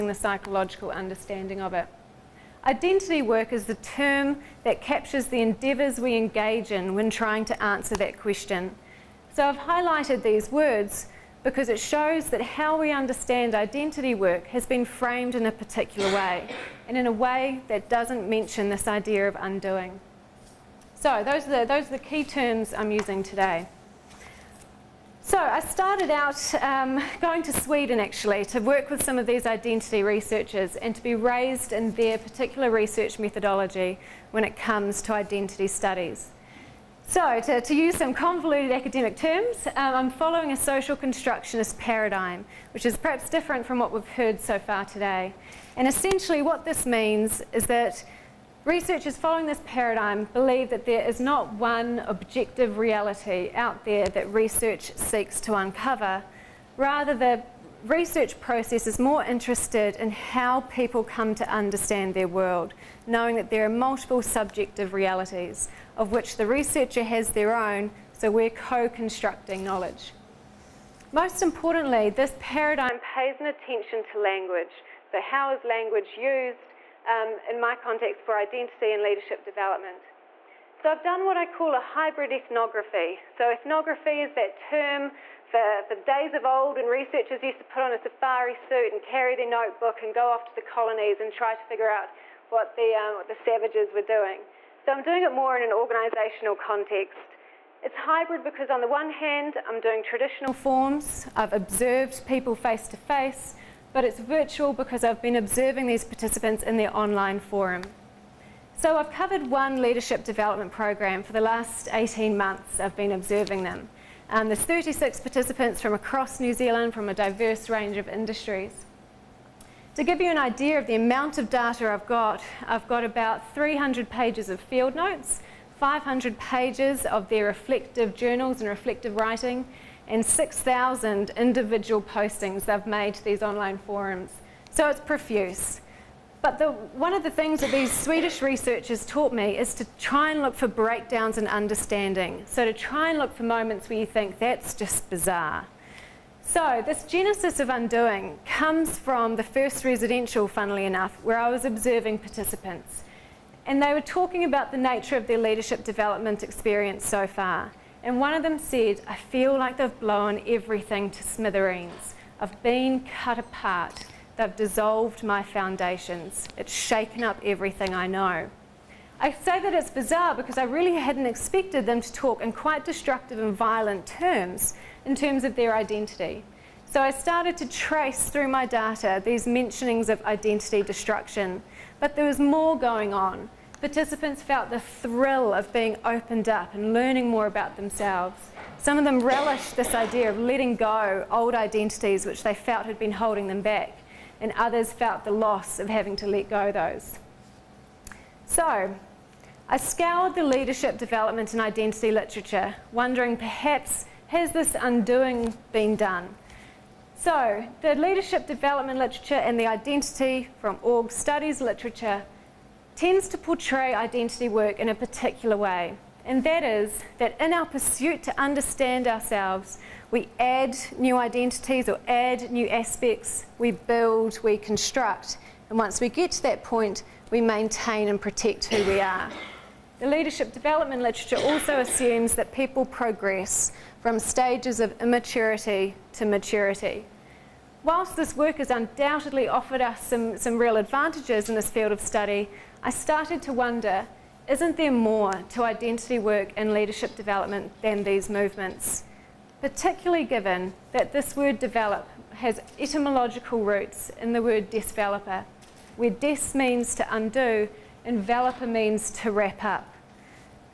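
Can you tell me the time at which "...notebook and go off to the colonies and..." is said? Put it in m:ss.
1:29.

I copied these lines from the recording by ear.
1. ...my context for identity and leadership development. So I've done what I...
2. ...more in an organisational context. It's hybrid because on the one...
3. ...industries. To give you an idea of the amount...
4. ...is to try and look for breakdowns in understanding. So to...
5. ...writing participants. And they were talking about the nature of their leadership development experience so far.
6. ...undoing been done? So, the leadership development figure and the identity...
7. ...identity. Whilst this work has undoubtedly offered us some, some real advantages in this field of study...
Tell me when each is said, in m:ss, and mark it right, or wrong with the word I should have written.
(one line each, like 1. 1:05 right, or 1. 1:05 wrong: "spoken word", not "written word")
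1. 1:17 right
2. 1:35 right
3. 1:58 right
4. 2:19 right
5. 2:31 wrong: "observing", not "writing"
6. 3:24 wrong: "literature", not "figure"
7. 3:56 wrong: "maturity", not "identity".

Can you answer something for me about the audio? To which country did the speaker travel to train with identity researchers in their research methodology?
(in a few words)
Sweden.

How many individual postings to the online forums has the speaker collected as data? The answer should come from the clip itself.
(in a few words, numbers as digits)
6,000.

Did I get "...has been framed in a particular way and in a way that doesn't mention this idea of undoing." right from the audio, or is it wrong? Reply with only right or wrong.
right.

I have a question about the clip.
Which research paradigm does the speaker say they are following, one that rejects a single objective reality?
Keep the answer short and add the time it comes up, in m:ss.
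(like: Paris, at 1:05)
social constructionist, at 0:40.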